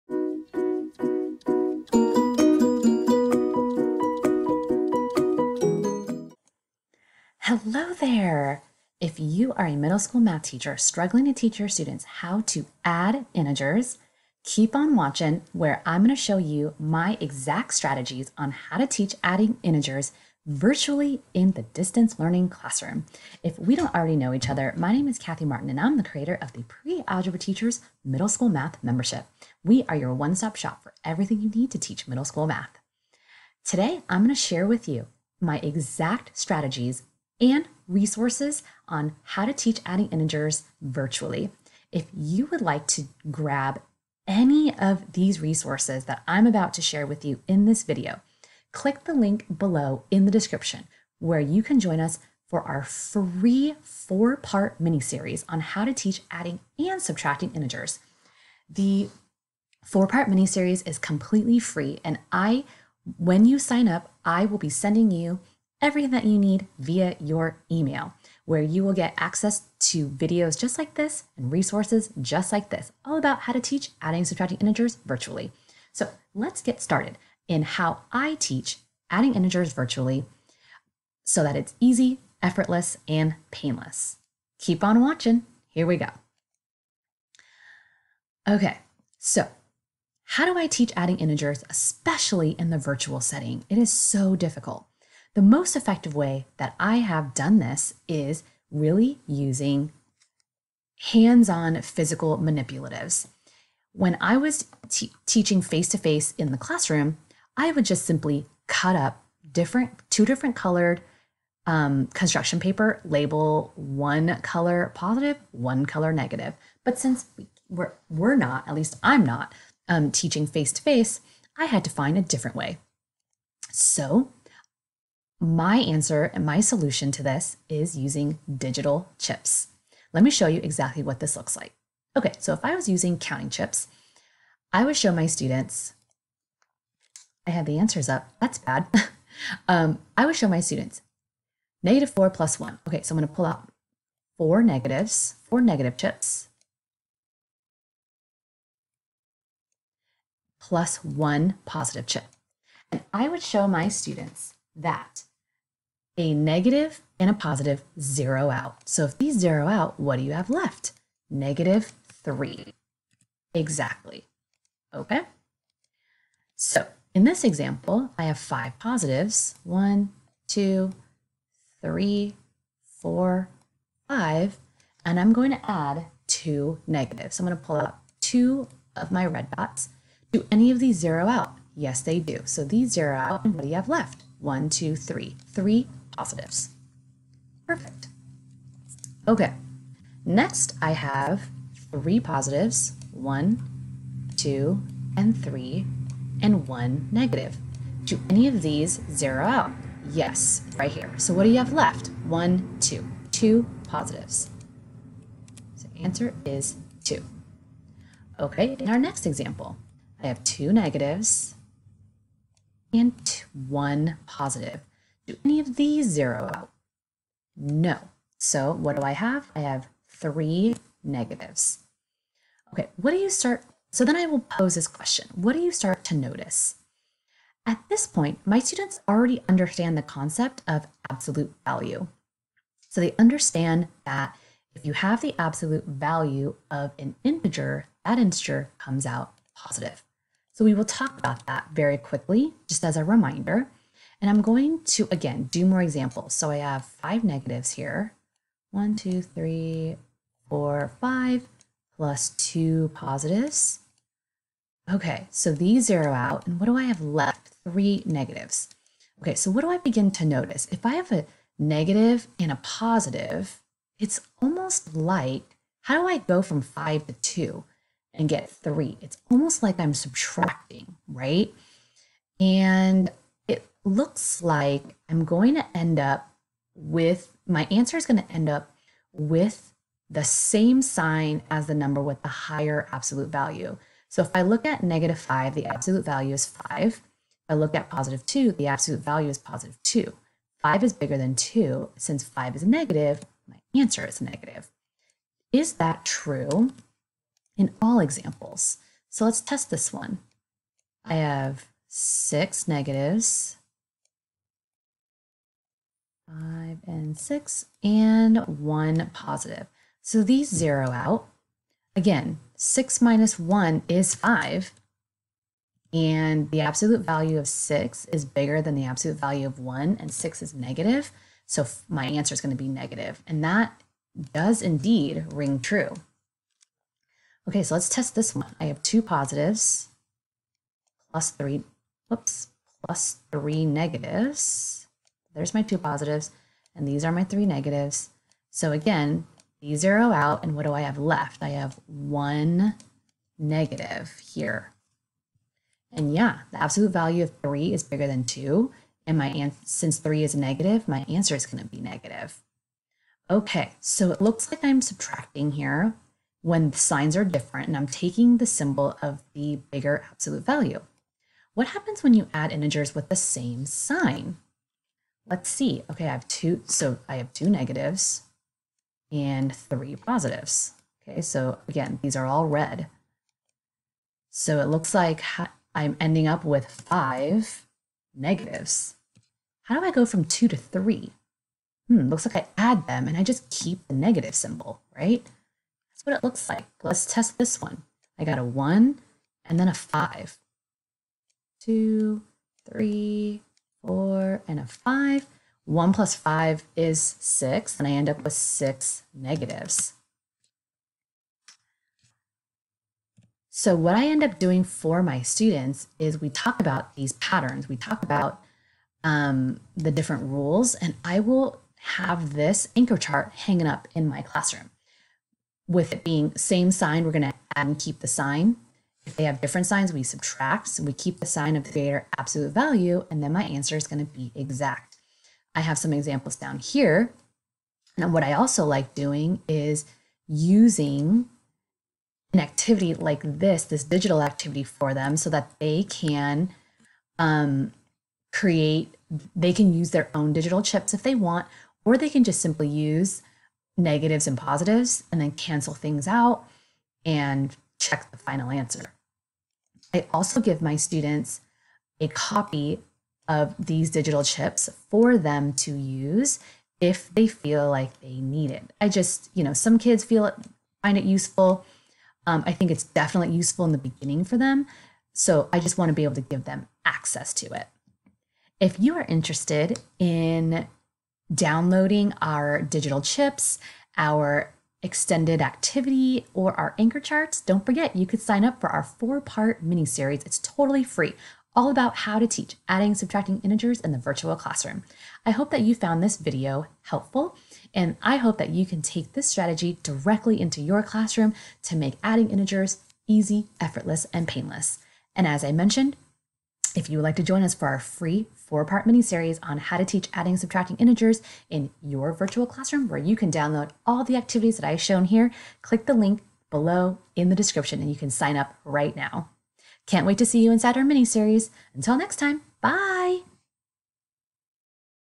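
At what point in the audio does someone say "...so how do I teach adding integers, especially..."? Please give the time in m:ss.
1:29.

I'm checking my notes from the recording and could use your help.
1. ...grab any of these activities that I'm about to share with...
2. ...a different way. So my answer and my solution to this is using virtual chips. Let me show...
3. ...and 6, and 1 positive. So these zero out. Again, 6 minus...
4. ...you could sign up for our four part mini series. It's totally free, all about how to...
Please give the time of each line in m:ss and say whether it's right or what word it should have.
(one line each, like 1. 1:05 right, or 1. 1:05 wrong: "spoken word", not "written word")
1. 0:43 wrong: "resources", not "activities"
2. 2:02 wrong: "digital", not "virtual"
3. 5:07 right
4. 7:57 right.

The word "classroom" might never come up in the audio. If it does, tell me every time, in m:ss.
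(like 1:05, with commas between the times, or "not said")
0:22, 1:46, 6:54, 8:04, 8:10, 8:22.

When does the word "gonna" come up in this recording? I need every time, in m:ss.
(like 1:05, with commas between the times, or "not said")
2:23, 5:51.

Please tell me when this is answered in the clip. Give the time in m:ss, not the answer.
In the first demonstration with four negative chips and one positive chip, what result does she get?
2:41.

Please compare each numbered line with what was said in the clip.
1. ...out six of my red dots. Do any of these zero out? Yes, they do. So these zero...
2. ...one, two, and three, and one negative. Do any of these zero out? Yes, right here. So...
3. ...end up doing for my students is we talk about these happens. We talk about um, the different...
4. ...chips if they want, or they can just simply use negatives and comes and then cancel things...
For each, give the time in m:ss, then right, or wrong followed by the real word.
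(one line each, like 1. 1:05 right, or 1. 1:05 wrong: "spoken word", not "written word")
1. 2:57 wrong: "two", not "six"
2. 3:13 right
3. 6:44 wrong: "patterns", not "happens"
4. 7:20 wrong: "positives", not "comes".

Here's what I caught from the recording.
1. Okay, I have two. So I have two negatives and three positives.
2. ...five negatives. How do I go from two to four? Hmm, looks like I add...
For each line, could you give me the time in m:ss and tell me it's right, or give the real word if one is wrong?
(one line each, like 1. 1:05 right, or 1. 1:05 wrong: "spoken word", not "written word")
1. 6:05 right
2. 6:16 wrong: "three", not "four".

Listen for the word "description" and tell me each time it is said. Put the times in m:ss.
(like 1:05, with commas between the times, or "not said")
0:50, 8:27.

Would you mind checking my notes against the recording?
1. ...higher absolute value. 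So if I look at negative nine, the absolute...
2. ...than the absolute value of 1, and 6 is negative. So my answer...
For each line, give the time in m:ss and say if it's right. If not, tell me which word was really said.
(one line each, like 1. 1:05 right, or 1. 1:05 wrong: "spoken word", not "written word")
1. 4:42 wrong: "five", not "nine"
2. 5:18 right.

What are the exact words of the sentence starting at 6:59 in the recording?
If they have different signs, we subtract.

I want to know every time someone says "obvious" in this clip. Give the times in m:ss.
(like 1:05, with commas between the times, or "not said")
not said.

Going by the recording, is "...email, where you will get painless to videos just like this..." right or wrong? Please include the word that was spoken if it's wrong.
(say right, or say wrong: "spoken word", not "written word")
wrong: "access", not "painless".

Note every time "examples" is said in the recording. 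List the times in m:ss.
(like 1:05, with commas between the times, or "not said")
2:47, 3:29, 4:05, 4:57, 7:05.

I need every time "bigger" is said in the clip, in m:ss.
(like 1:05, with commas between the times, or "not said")
4:50, 5:18, 5:47, 5:59.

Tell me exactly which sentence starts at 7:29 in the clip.
I also give my students a copy of these digital chips for them to use if they feel like they need it.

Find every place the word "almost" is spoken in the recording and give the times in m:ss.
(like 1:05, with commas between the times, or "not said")
4:24, 4:29.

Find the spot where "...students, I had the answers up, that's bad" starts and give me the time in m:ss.
2:15.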